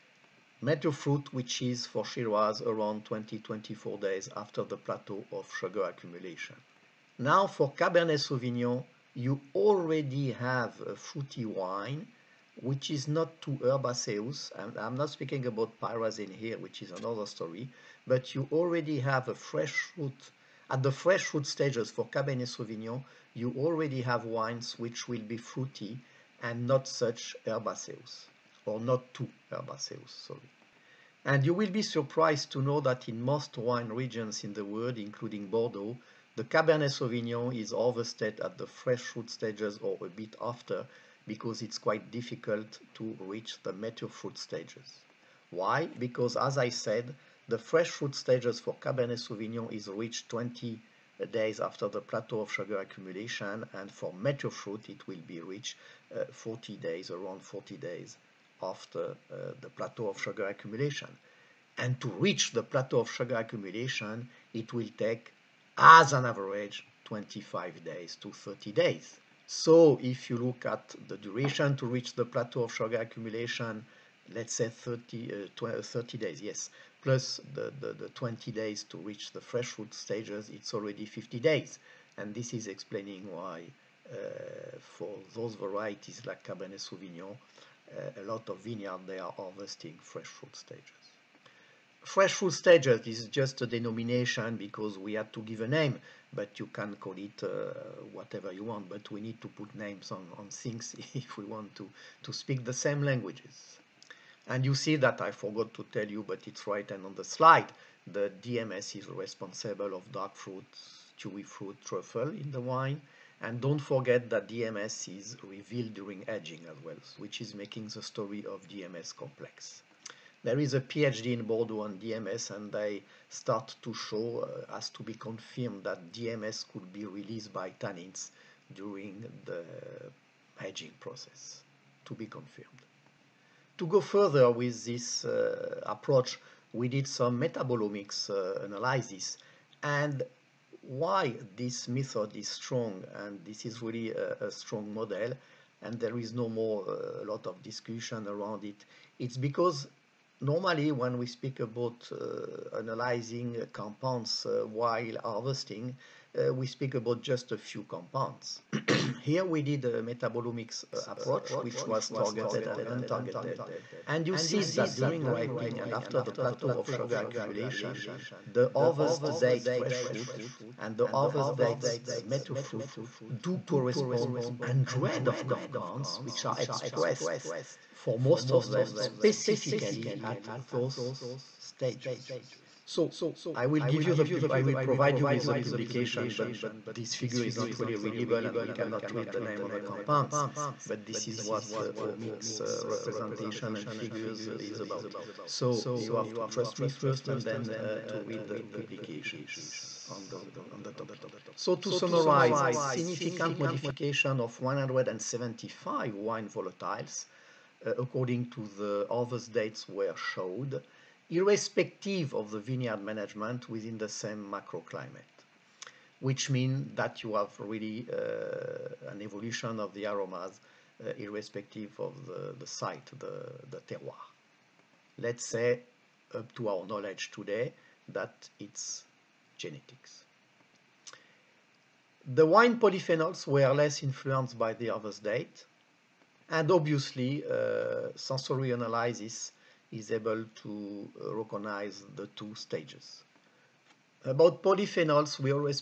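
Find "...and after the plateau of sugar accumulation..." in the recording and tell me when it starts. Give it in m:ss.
2:45.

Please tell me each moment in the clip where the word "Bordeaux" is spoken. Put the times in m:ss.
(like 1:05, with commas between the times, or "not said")
0:35, 2:01.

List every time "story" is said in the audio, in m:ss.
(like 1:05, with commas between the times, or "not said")
0:17, 1:58.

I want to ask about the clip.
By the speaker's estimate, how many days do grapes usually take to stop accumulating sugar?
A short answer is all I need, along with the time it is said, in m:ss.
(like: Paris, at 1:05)
25 to 30 days, at 1:07.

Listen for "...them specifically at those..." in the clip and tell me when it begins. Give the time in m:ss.
2:58.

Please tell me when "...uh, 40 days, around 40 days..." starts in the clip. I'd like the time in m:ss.
0:56.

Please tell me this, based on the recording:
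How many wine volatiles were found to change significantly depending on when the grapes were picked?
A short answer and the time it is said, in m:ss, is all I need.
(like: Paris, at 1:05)
175, at 3:24.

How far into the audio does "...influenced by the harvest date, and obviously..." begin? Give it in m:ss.
3:54.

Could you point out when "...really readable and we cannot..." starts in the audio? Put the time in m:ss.
3:07.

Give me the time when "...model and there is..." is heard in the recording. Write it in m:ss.
2:24.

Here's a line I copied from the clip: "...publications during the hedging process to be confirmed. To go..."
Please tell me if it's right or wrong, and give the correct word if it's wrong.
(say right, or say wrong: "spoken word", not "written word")
wrong: "tannins", not "publications".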